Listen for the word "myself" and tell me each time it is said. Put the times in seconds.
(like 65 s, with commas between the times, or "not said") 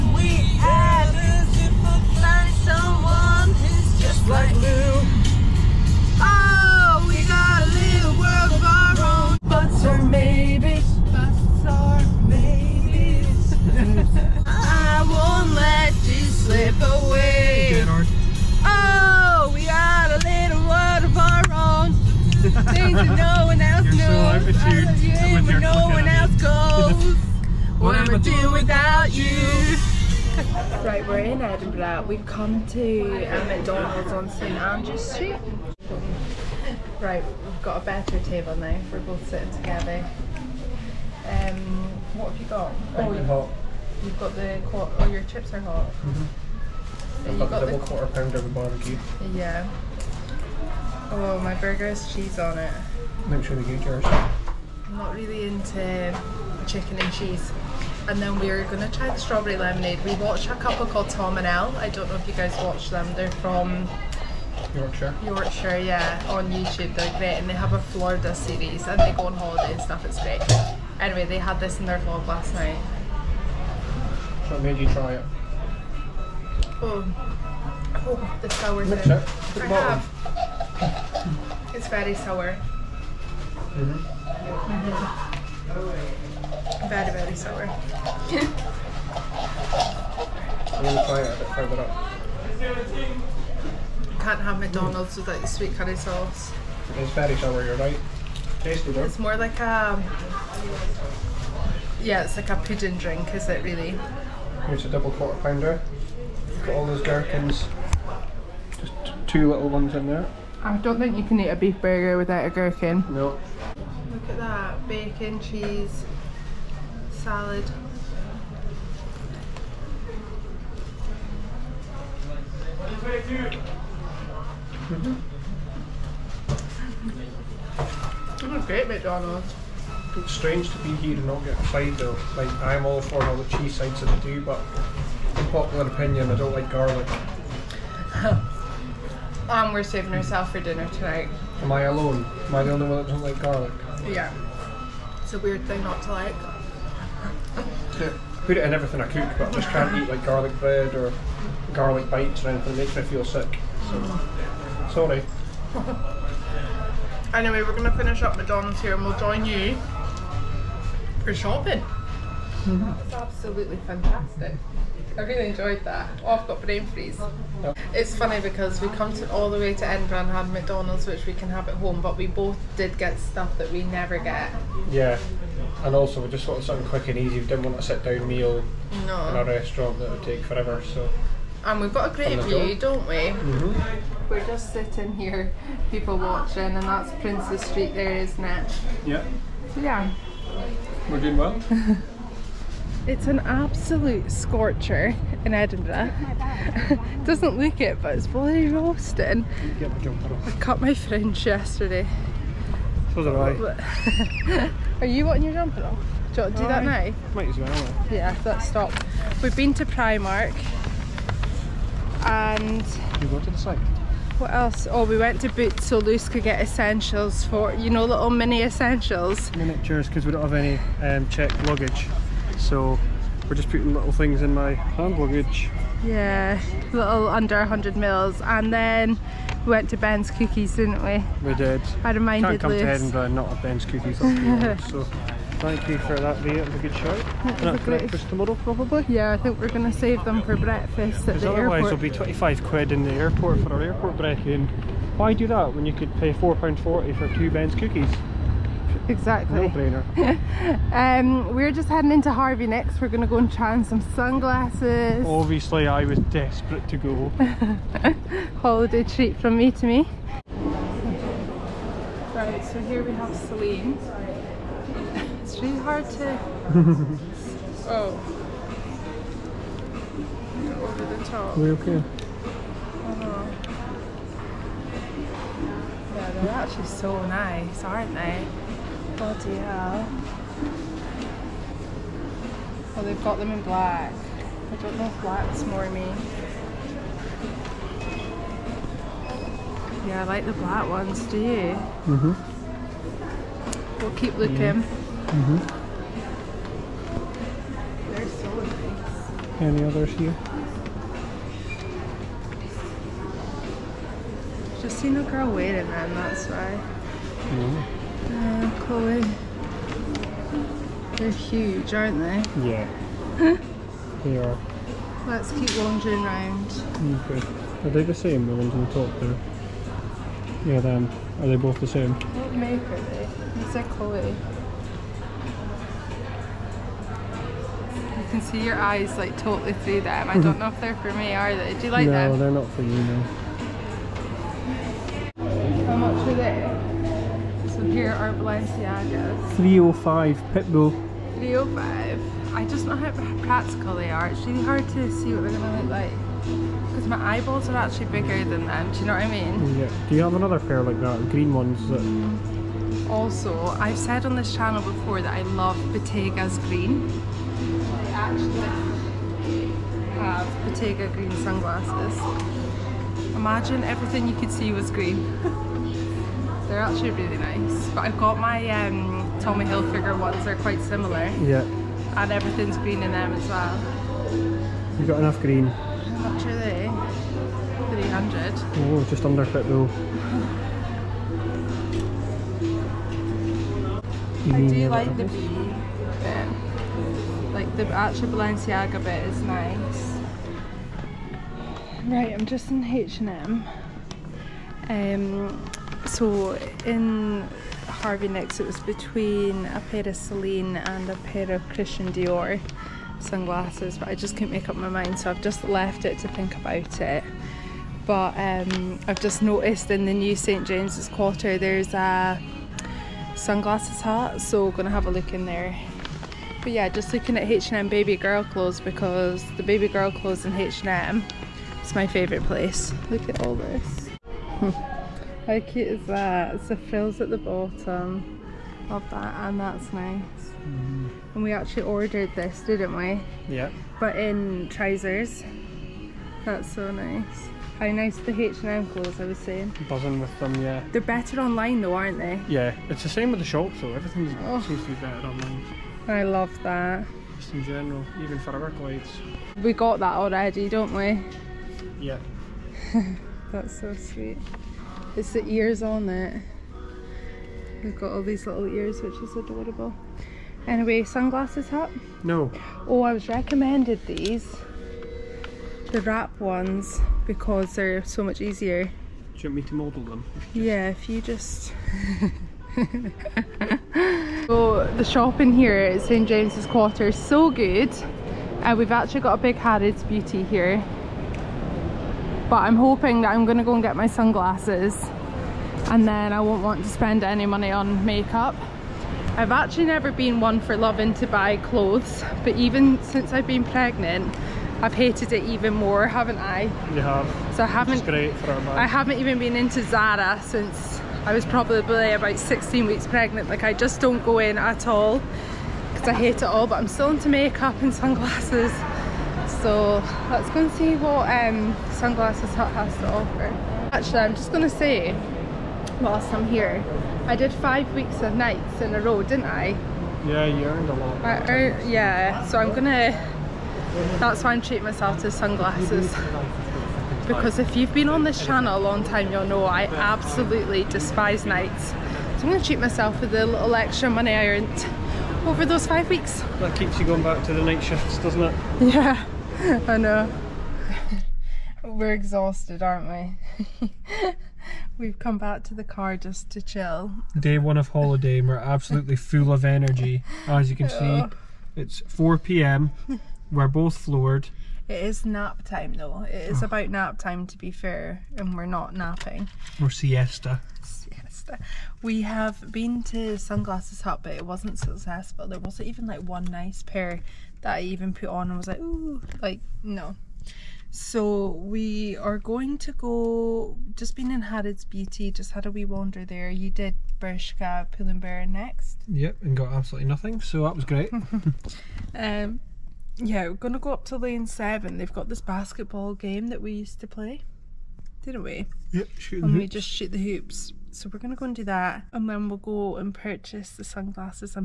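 524 s, 532 s.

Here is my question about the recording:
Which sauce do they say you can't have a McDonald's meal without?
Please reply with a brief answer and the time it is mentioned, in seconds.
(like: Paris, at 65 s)
Sweet curry sauce, at 95 s.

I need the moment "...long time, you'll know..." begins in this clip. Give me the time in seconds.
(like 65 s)
528 s.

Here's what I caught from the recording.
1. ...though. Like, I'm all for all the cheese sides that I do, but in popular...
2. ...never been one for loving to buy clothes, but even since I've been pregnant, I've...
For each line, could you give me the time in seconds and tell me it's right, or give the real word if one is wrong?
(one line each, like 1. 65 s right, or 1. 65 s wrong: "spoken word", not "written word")
1. 131 s right
2. 489 s right.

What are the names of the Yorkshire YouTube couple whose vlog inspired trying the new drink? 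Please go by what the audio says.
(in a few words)
Tom and Elle.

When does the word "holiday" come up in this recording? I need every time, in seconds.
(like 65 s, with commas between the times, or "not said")
69 s, 258 s, 547 s.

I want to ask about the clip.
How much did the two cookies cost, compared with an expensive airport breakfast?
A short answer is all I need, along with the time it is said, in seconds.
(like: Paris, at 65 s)
£4.40, at 246 s.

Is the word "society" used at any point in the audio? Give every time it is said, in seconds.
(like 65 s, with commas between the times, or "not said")
not said.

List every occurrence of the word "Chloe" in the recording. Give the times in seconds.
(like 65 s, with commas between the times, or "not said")
308 s, 323 s.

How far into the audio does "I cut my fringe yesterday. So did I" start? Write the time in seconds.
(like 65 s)
199 s.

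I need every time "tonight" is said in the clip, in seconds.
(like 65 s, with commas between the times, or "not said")
140 s.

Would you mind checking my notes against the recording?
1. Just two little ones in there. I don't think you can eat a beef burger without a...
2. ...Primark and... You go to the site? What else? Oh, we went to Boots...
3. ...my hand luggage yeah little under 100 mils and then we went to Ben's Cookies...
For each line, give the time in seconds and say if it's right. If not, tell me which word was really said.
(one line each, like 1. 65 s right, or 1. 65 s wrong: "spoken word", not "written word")
1. 108 s right
2. 209 s right
3. 224 s right.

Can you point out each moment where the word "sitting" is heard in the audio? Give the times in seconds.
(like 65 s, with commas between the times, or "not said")
39 s, 184 s.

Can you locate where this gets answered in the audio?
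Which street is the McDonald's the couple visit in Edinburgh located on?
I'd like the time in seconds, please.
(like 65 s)
34 s.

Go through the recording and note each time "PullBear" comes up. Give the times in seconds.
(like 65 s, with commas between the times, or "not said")
577 s.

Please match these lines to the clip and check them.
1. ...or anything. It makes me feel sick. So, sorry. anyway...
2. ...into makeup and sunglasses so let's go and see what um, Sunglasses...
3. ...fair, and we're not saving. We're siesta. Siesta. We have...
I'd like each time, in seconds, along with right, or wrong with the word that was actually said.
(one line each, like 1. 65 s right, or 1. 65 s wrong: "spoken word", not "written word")
1. 152 s right
2. 507 s right
3. 557 s wrong: "napping", not "saving".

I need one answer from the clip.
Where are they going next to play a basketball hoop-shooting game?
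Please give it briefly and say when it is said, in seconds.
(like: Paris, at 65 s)
Lane 7, at 584 s.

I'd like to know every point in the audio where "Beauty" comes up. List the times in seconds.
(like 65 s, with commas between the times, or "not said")
480 s, 574 s.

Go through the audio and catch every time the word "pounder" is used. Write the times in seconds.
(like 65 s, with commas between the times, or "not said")
48 s, 105 s.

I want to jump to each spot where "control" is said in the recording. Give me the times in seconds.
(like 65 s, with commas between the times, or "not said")
not said.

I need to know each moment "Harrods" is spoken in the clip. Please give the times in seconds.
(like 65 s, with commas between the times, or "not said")
479 s, 574 s.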